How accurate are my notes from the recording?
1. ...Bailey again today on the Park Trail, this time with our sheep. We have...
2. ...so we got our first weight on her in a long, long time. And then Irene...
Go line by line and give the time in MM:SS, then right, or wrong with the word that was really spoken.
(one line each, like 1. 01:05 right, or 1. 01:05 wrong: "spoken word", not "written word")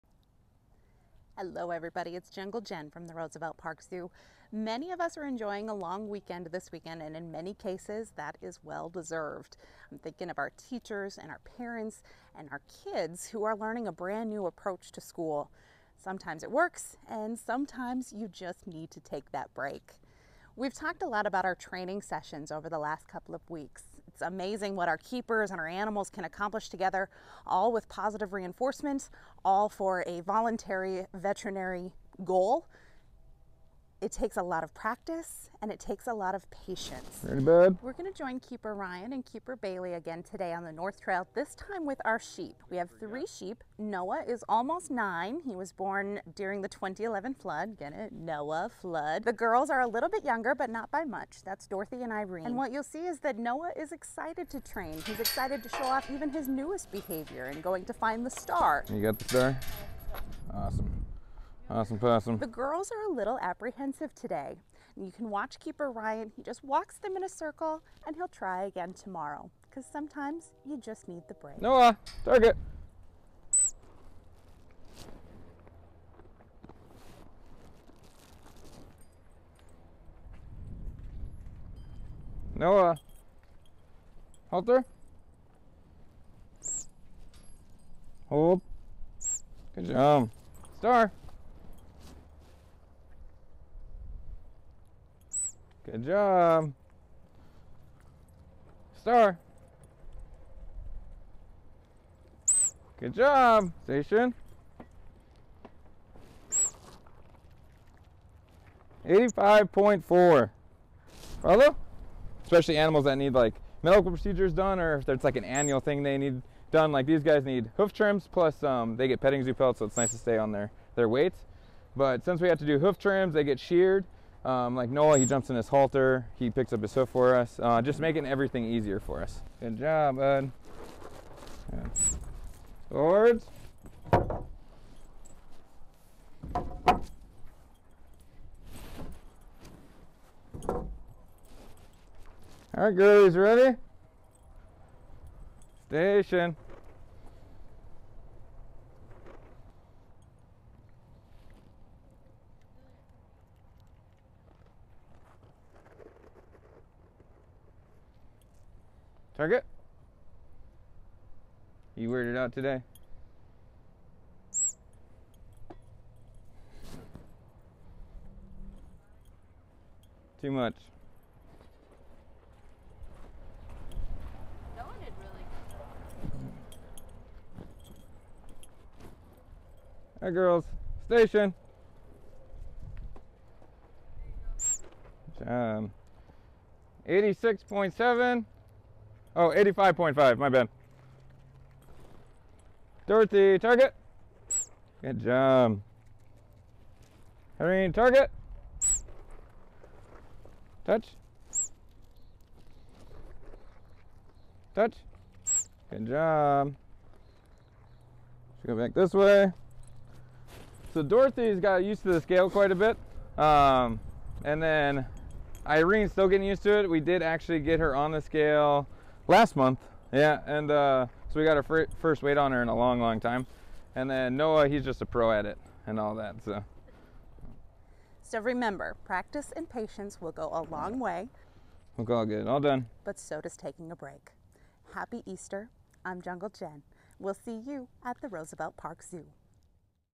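1. 00:39 wrong: "North", not "Park"
2. 03:41 wrong: "Noah", not "Irene".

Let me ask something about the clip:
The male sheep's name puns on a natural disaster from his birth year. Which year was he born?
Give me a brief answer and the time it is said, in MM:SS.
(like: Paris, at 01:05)
2011, at 00:46.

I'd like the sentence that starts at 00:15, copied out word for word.
Sometimes it works, and sometimes you just need to take that break.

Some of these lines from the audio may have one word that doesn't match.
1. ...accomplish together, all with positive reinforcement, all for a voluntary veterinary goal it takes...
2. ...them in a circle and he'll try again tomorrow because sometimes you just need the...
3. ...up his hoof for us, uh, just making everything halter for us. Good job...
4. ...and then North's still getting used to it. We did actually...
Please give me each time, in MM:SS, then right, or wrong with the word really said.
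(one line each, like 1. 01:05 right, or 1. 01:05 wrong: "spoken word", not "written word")
1. 00:26 right
2. 01:06 right
3. 02:06 wrong: "easier", not "halter"
4. 03:34 wrong: "Irene", not "North".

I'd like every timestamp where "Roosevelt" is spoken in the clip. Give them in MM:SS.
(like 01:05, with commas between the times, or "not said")
00:03, 03:58.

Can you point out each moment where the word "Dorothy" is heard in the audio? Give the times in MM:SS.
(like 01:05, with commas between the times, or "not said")
00:51, 03:13, 03:31.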